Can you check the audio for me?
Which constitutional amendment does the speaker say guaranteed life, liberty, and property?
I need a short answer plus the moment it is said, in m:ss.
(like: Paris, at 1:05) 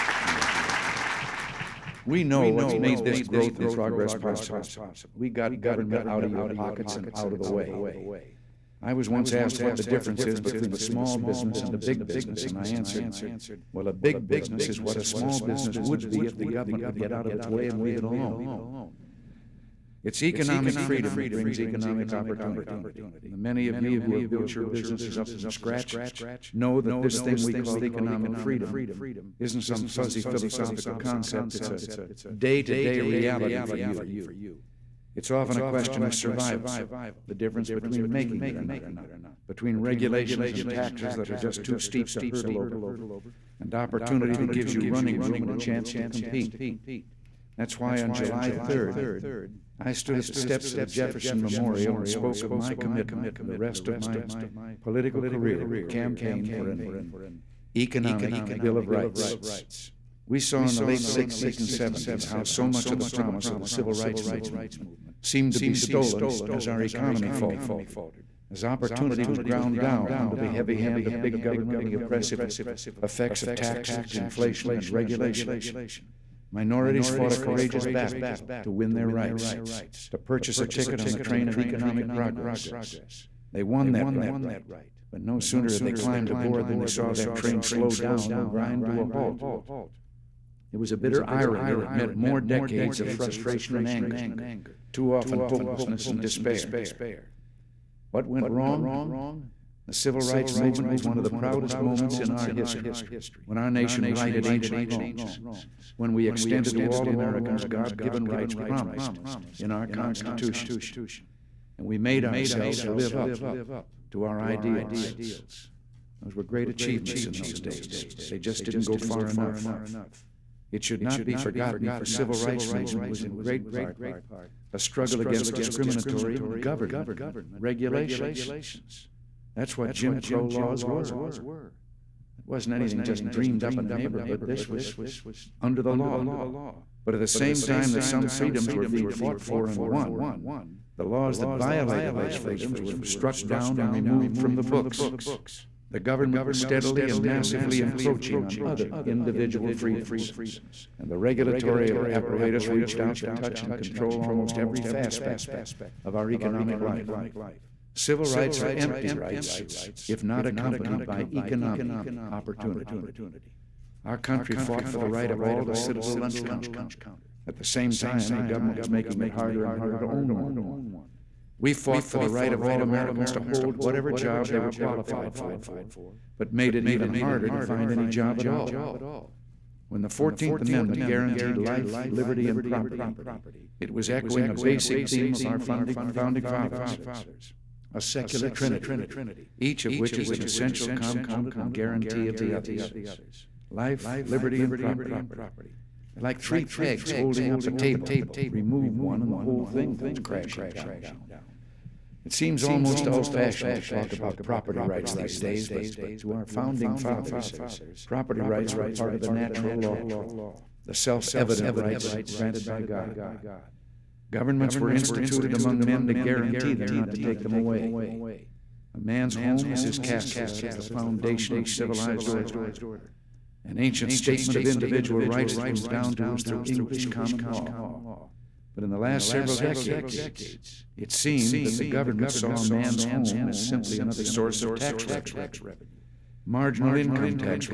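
14th Amendment, at 3:00.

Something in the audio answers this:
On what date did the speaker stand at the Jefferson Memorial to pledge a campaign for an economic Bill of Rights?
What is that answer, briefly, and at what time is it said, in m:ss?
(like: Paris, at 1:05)
July 3rd, at 0:48.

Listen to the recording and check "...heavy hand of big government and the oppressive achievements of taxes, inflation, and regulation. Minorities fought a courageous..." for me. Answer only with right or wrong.
wrong.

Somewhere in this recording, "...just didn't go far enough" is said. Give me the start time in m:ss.
1:58.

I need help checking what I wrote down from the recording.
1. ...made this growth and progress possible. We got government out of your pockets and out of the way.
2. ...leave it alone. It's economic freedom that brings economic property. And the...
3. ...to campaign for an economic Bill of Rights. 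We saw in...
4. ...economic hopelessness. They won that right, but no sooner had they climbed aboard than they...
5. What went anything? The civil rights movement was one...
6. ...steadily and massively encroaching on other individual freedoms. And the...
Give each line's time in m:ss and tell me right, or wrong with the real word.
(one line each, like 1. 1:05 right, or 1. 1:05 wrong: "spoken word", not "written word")
1. 0:02 right
2. 0:17 wrong: "opportunity", not "property"
3. 0:55 right
4. 1:21 wrong: "progress", not "hopelessness"
5. 1:38 wrong: "wrong", not "anything"
6. 2:26 right.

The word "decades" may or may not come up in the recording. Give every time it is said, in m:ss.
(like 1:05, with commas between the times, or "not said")
1:32, 3:49.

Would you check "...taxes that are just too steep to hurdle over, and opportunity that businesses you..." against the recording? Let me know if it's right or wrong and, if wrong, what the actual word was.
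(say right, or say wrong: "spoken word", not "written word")
wrong: "gives", not "businesses".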